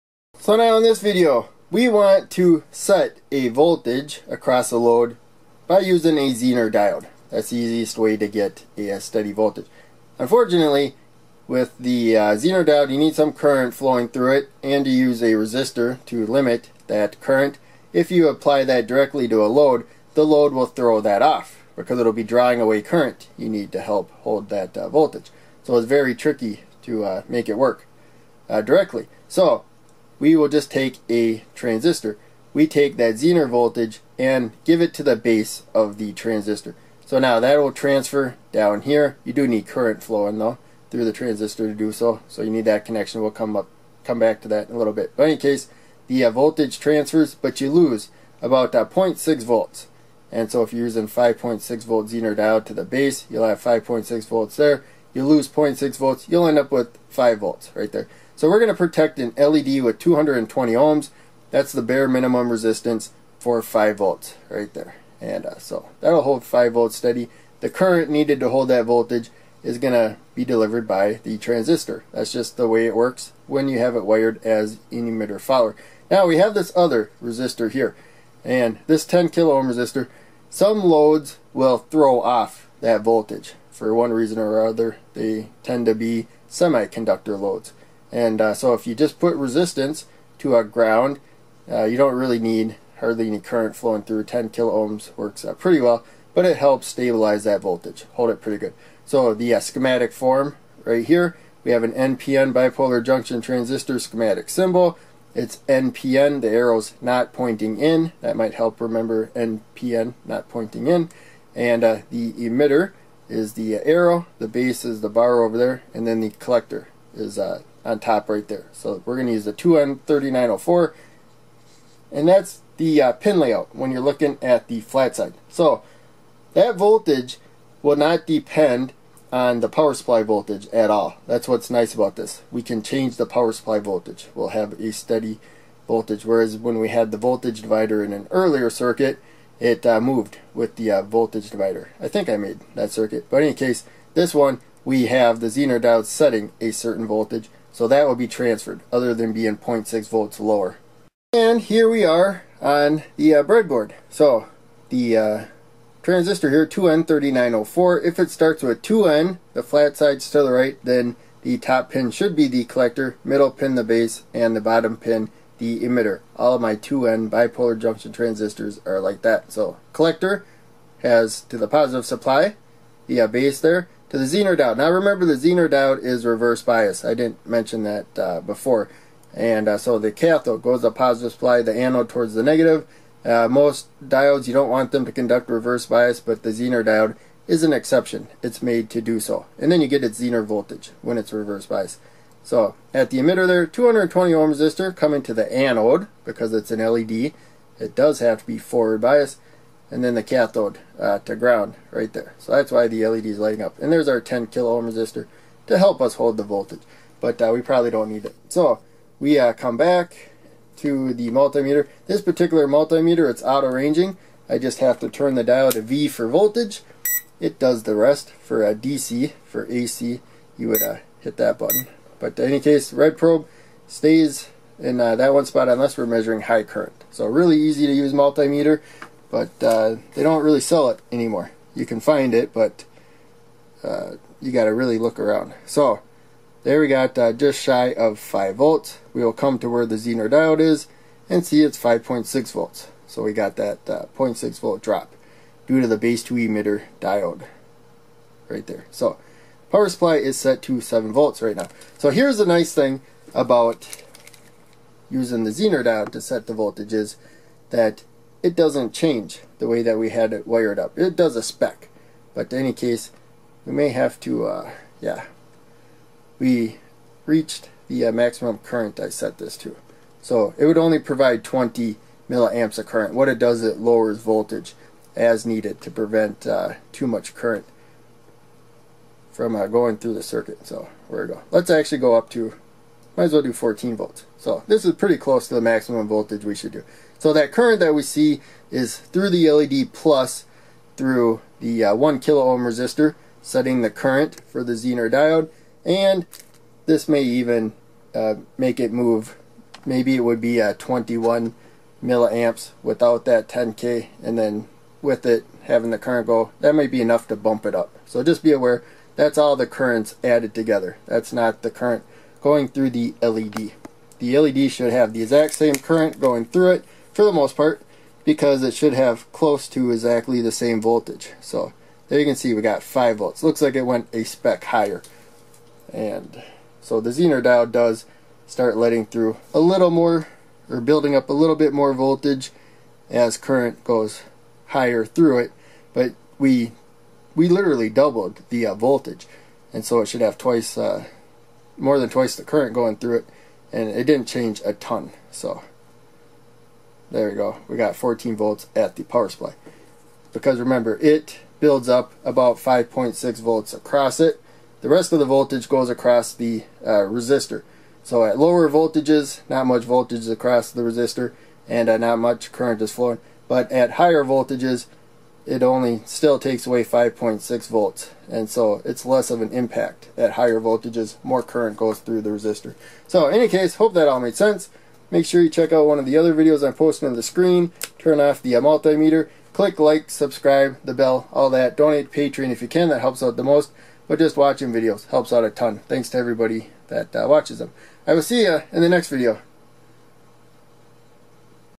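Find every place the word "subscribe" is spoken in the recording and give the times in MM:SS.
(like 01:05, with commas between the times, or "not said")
06:20.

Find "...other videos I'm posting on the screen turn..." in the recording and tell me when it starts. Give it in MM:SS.
06:16.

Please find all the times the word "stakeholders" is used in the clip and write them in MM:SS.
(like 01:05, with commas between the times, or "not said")
not said.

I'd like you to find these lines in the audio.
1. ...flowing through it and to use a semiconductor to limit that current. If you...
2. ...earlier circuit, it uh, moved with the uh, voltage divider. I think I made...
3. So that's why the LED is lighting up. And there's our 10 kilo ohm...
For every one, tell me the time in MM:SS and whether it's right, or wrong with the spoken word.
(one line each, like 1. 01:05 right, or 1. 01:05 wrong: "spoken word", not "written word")
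1. 00:13 wrong: "resistor", not "semiconductor"
2. 02:18 right
3. 03:22 right.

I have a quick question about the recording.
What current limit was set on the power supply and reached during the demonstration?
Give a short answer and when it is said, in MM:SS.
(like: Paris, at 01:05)
20 milliamps, at 04:31.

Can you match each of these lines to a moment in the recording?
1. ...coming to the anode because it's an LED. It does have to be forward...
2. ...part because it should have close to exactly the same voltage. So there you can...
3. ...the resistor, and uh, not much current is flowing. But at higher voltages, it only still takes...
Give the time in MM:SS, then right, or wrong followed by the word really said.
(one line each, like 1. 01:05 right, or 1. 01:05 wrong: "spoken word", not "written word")
1. 03:14 right
2. 05:17 right
3. 06:00 right.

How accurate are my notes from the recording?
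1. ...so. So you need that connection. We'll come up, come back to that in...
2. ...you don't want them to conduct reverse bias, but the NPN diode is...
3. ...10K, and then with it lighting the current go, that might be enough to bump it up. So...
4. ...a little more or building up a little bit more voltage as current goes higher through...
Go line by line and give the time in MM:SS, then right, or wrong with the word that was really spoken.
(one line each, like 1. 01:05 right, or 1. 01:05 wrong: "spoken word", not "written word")
1. 00:41 right
2. 03:04 wrong: "Zener", not "NPN"
3. 05:03 wrong: "having", not "lighting"
4. 05:29 right.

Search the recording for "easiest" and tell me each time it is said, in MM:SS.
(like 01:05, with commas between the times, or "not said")
00:07.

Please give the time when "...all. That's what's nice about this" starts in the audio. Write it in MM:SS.
02:10.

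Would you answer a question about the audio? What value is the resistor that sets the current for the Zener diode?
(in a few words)
1 kilo ohm.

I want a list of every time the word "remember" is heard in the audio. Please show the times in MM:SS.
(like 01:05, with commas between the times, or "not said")
01:48, 02:54, 05:50.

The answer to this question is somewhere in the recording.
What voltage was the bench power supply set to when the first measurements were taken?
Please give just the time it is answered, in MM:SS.
04:10.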